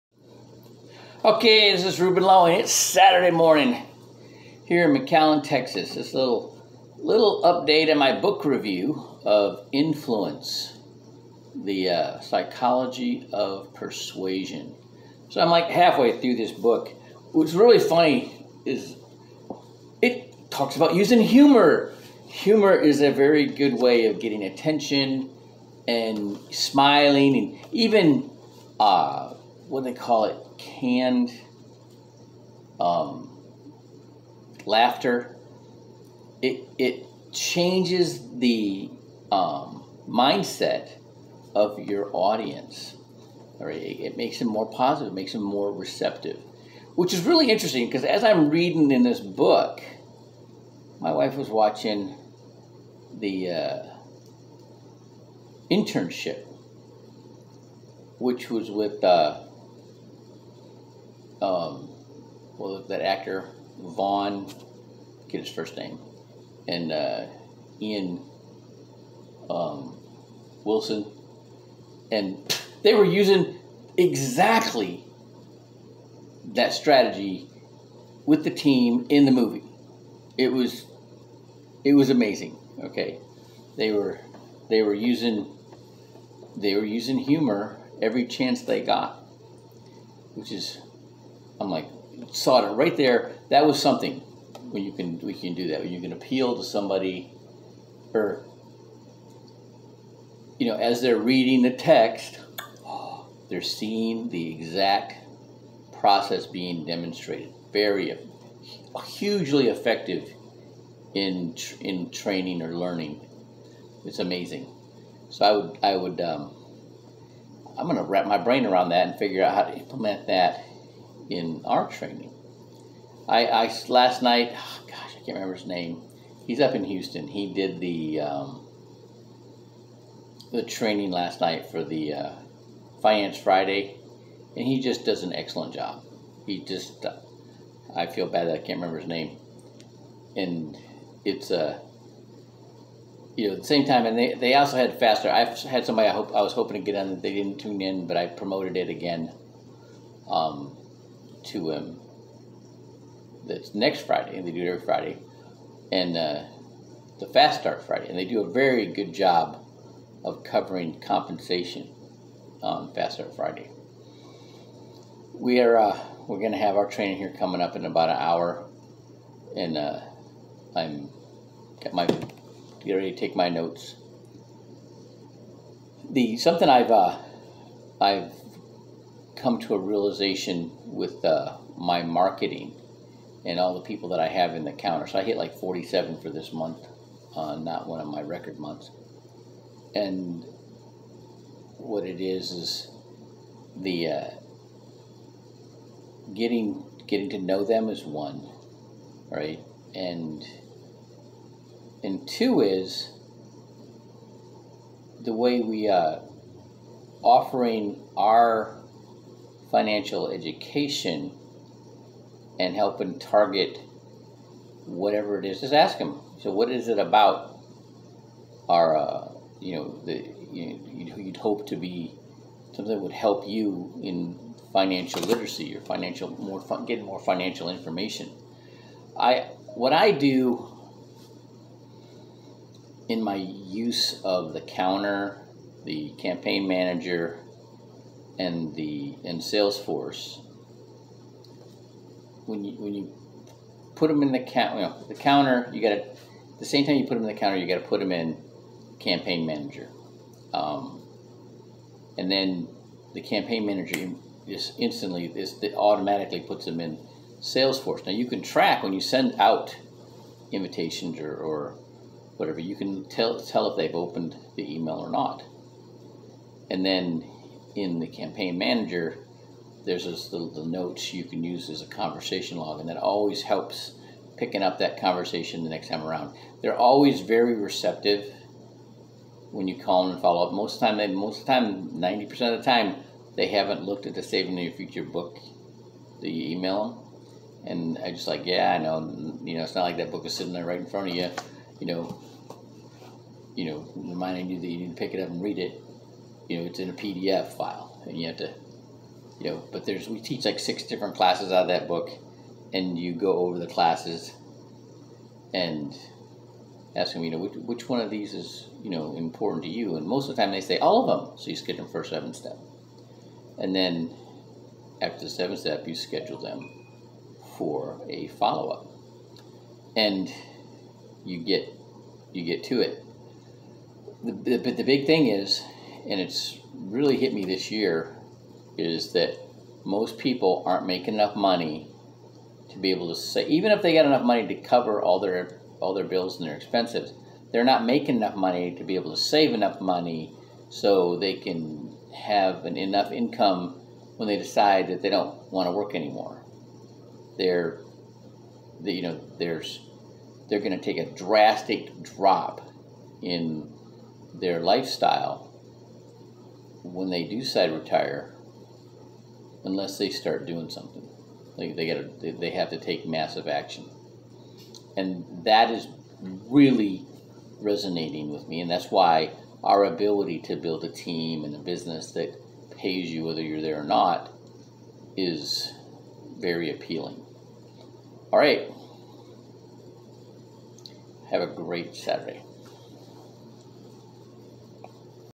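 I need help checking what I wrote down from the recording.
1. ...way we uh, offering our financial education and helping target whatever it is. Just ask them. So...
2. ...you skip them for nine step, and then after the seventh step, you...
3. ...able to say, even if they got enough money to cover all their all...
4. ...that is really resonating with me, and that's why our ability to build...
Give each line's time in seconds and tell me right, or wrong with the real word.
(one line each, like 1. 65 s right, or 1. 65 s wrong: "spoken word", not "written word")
1. 205 s right
2. 311 s wrong: "seven", not "nine"
3. 332 s right
4. 365 s right.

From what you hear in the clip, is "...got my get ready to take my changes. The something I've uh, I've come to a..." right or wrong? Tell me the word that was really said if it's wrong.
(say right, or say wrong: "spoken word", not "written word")
wrong: "notes", not "changes".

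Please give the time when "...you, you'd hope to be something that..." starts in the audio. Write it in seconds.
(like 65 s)
220 s.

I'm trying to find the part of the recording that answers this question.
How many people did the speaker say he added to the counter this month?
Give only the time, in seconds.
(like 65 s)
185 s.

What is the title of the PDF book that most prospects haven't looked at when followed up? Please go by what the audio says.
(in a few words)
Saving Your Future.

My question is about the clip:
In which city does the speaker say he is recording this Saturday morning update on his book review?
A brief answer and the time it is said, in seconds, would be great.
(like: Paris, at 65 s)
McAllen, Texas, at 5 s.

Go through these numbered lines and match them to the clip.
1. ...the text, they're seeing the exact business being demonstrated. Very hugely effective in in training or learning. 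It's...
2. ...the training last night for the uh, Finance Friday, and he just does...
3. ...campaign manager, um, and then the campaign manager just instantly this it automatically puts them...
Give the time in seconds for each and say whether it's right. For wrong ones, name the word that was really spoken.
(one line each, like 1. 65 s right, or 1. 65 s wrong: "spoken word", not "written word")
1. 101 s wrong: "process", not "business"
2. 130 s right
3. 248 s right.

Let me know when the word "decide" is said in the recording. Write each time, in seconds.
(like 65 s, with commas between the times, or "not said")
344 s, 357 s.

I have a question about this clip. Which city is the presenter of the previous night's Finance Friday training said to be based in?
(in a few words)
Houston.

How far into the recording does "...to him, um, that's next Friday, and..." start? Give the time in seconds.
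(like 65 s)
151 s.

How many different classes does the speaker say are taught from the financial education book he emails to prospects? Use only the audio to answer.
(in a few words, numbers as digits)
6.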